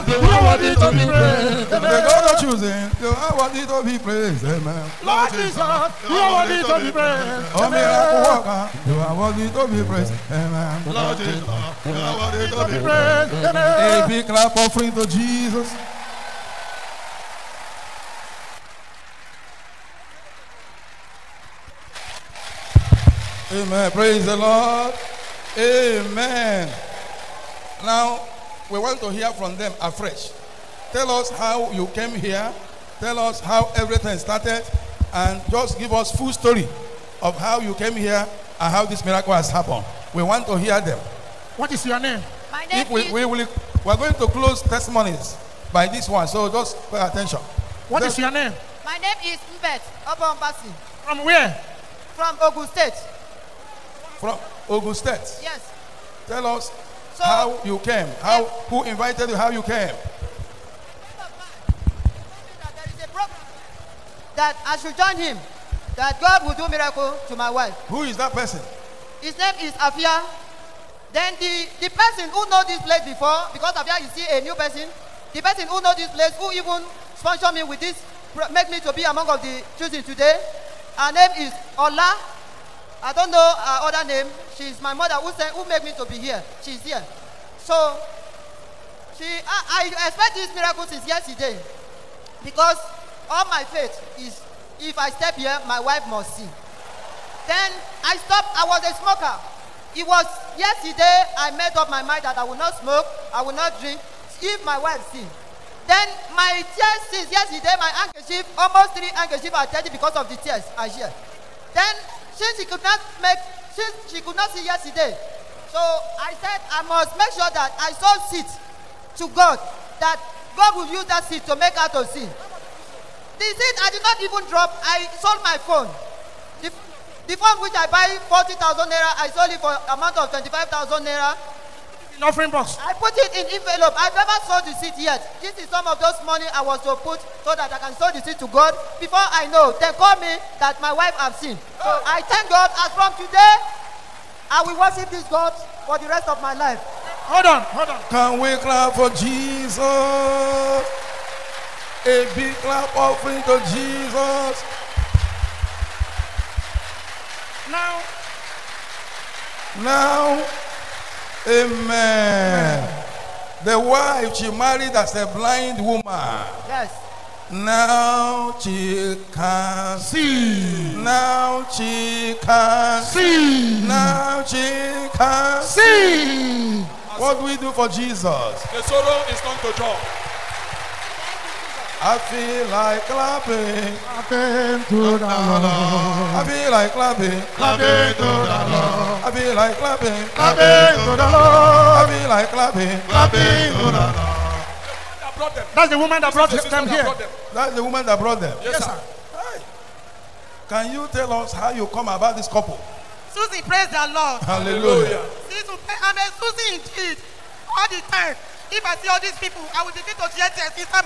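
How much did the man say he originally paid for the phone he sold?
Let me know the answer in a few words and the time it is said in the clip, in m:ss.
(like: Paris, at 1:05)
40,000 naira, at 2:08.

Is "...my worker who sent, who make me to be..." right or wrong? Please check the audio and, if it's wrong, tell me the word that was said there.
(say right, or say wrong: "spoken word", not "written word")
wrong: "mother", not "worker".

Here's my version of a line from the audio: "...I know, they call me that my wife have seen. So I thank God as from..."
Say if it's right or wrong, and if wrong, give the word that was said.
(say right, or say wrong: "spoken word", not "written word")
right.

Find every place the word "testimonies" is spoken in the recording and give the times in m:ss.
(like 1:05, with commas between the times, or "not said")
0:44.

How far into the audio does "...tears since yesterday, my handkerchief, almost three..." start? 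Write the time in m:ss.
1:46.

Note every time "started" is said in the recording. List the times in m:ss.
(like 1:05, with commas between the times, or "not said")
0:34.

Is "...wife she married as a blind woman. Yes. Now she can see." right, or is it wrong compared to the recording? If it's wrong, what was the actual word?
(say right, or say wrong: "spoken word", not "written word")
right.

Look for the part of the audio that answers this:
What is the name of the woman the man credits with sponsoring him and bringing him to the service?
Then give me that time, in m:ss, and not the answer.
1:21.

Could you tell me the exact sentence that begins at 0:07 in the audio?
Oh, miracle worker, you are worthy to be praised, amen.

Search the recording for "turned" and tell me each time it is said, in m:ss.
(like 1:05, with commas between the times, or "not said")
2:59.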